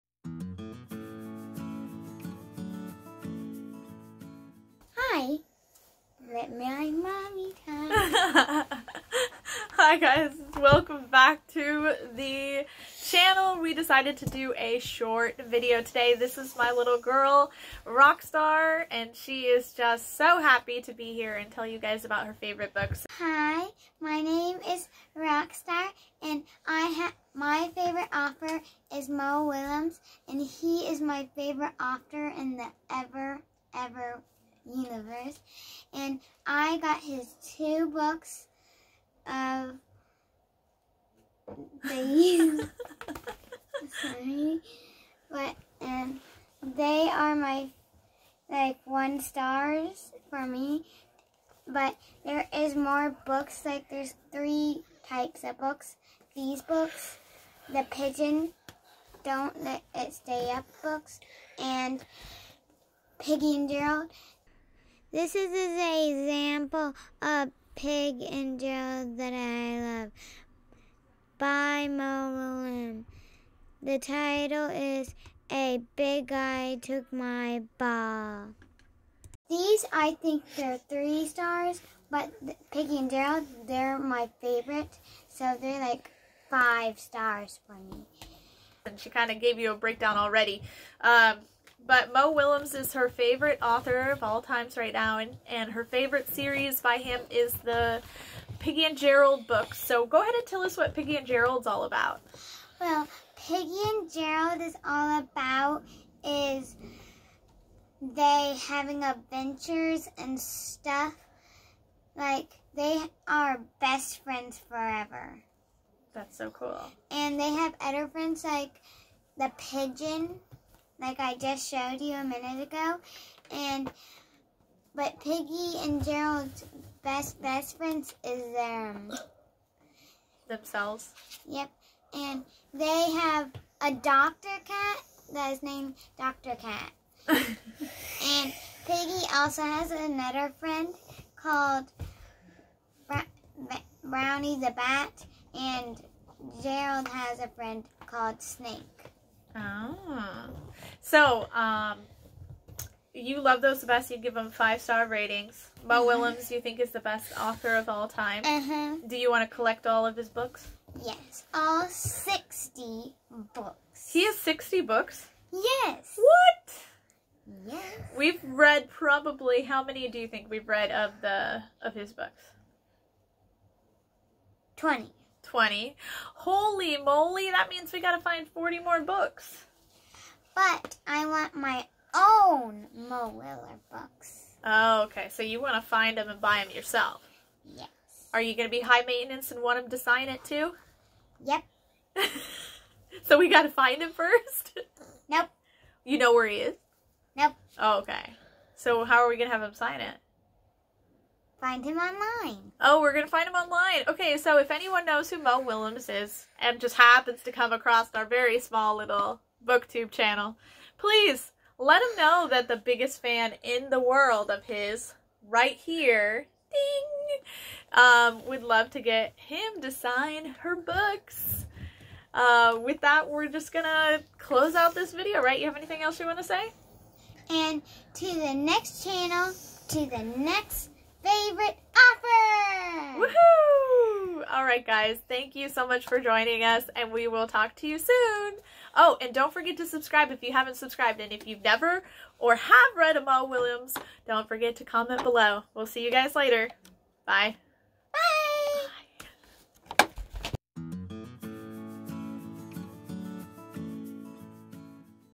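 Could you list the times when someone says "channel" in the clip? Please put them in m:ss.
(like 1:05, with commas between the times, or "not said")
0:13, 3:30, 3:49.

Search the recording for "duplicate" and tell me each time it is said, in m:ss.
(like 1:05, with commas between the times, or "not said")
not said.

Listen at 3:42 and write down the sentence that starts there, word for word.
Uh, with that, we're just going to close out this video, right?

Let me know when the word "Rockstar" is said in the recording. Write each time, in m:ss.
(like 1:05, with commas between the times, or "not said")
0:17, 0:25.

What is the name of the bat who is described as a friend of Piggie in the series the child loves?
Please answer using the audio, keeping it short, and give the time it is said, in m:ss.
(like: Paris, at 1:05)
Brownie the Bat, at 2:24.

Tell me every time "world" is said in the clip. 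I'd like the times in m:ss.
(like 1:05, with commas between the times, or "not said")
3:33.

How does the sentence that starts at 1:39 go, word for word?
So go ahead and tell us what Piggie and Gerald's all about.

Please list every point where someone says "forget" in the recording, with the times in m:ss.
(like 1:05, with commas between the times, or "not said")
3:59, 4:04.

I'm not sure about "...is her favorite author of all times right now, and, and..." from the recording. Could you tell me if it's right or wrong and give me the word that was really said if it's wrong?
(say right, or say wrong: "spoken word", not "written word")
right.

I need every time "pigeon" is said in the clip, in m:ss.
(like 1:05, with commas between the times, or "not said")
0:57, 1:59.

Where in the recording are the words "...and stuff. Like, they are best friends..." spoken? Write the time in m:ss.
1:50.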